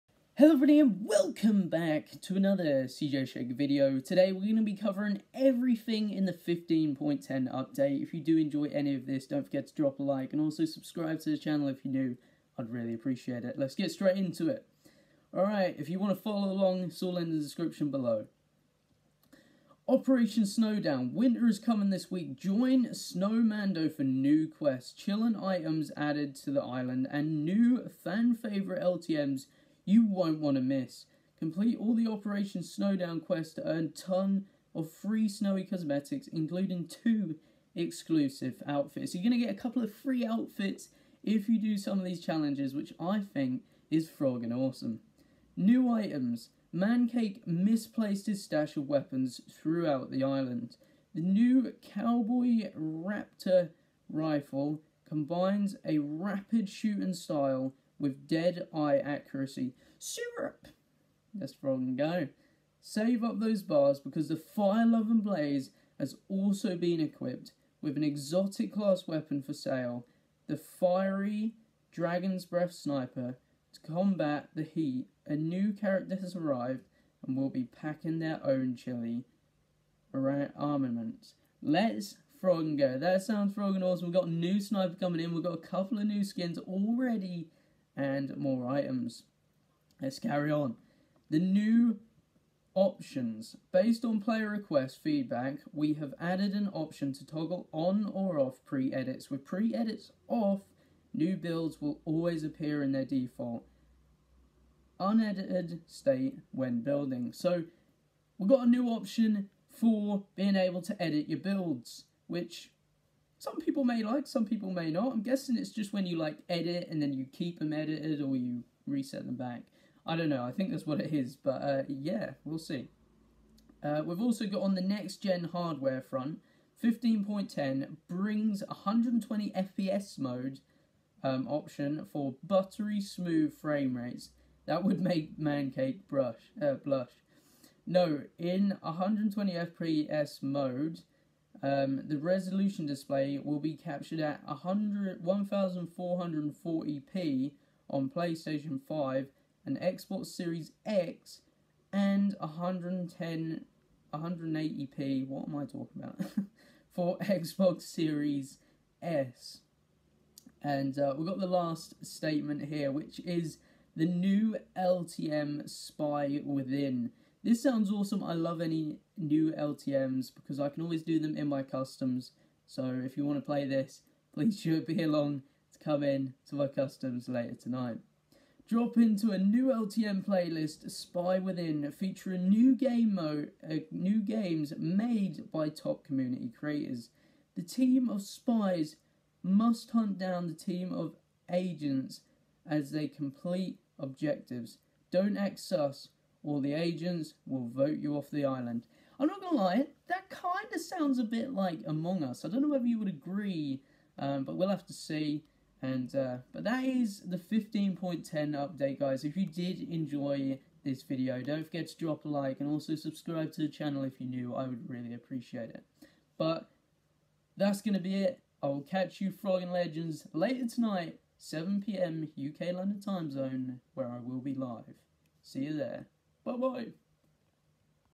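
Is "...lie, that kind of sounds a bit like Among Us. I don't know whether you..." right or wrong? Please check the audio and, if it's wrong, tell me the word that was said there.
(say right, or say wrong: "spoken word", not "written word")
right.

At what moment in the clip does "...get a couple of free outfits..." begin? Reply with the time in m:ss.
0:39.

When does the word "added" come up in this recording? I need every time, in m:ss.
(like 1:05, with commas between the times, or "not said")
0:25, 1:36.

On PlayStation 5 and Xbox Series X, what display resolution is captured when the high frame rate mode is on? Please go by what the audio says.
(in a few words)
1440p.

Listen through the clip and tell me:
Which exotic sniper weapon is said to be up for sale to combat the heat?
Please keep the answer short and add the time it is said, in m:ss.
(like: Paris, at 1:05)
Fiery Dragon's Breath Sniper, at 1:10.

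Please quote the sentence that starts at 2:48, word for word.
I love any new LTMs because I can always do them in my customs.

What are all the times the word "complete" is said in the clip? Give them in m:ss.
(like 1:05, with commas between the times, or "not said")
0:31, 3:13.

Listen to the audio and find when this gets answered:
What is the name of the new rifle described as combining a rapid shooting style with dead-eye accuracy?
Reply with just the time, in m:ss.
0:51.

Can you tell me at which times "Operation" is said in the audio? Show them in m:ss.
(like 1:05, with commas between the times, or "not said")
0:19, 0:32.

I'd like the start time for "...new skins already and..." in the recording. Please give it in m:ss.
1:26.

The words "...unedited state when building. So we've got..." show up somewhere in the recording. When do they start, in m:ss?
1:44.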